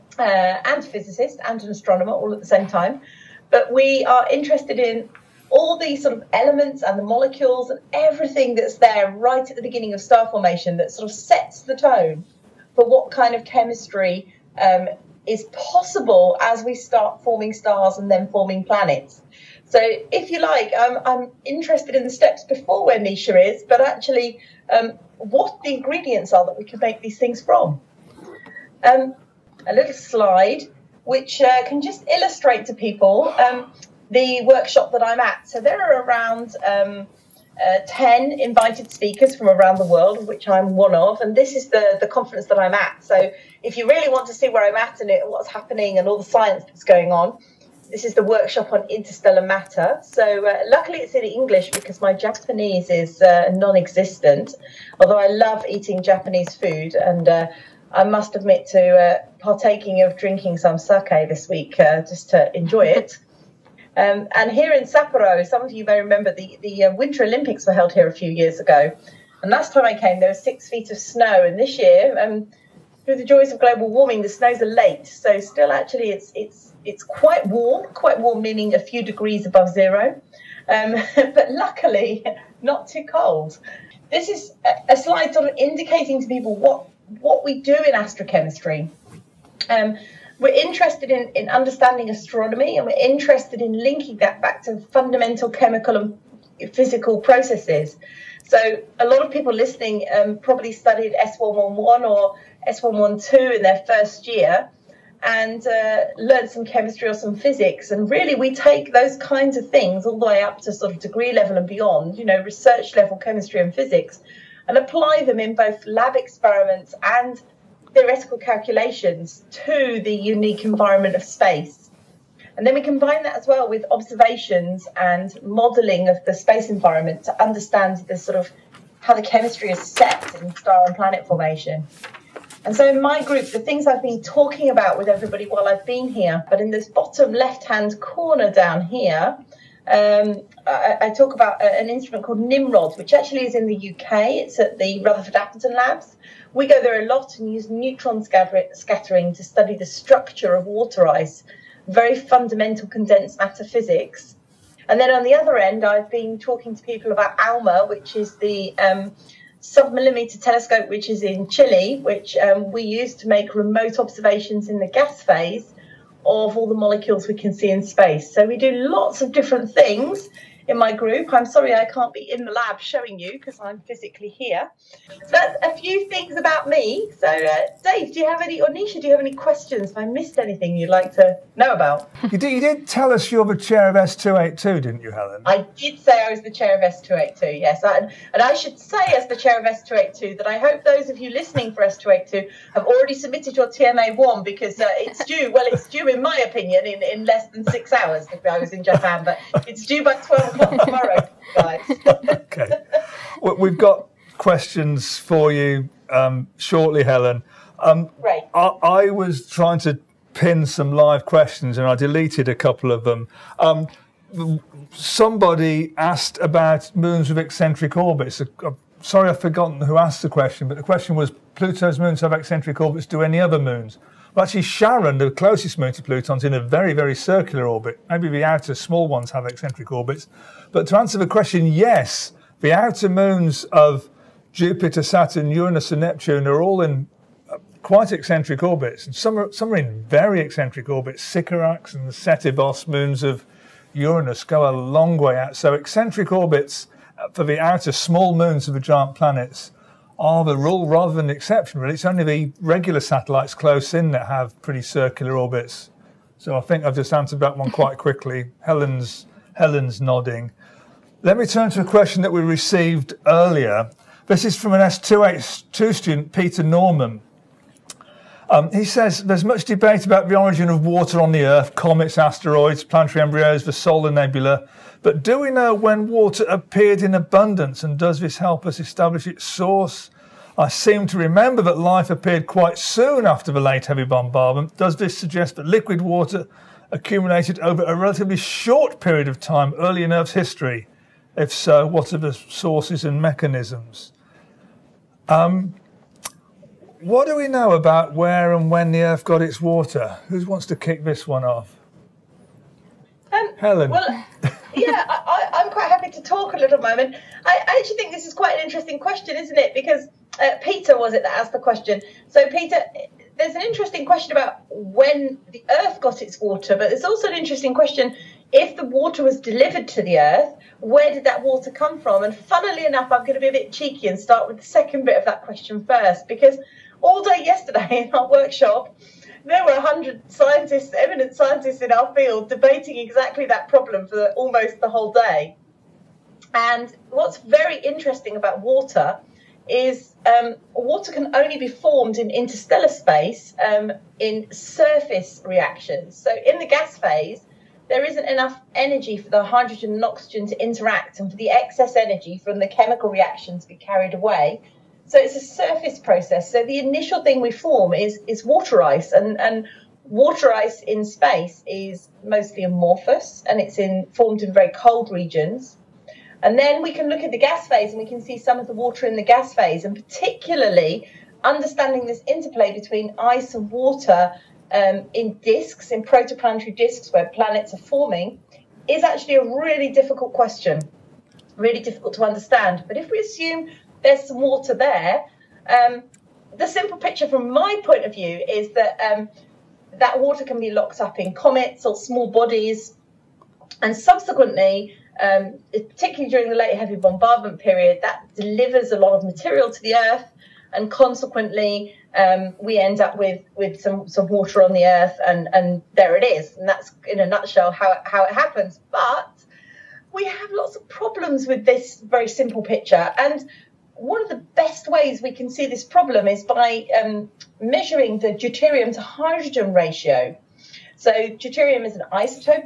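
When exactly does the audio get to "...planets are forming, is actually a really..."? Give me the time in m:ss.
6:17.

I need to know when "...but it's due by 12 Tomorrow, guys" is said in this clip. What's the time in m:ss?
3:19.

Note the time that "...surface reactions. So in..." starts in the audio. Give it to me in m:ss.
5:44.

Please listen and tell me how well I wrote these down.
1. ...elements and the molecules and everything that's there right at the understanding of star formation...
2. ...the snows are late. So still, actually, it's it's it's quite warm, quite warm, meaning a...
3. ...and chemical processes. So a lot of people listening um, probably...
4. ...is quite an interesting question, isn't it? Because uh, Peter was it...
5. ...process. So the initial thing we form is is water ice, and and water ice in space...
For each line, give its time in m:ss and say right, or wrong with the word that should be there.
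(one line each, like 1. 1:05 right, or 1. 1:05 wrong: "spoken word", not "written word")
1. 0:06 wrong: "beginning", not "understanding"
2. 1:14 right
3. 1:35 wrong: "physical", not "chemical"
4. 5:08 right
5. 5:55 right.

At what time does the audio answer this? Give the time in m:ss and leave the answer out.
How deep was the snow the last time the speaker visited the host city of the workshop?
1:10.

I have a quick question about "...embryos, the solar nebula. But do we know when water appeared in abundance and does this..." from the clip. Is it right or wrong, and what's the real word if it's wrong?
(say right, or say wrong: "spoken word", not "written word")
right.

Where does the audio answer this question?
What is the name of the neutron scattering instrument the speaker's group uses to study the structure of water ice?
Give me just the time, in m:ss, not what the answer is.
2:22.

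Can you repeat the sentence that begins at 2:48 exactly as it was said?
So we do lots of different things in my group.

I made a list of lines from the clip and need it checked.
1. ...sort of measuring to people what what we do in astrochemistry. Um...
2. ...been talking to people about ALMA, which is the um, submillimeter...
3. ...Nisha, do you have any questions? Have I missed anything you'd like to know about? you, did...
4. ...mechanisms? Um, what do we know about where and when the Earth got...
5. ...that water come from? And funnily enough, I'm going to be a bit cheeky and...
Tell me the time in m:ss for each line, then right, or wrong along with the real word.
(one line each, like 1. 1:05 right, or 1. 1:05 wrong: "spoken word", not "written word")
1. 1:25 wrong: "indicating", not "measuring"
2. 2:36 right
3. 2:58 right
4. 4:53 right
5. 5:21 right.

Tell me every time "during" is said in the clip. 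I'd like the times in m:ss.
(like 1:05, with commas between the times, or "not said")
6:36.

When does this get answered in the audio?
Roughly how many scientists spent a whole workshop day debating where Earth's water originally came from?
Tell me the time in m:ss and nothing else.
5:29.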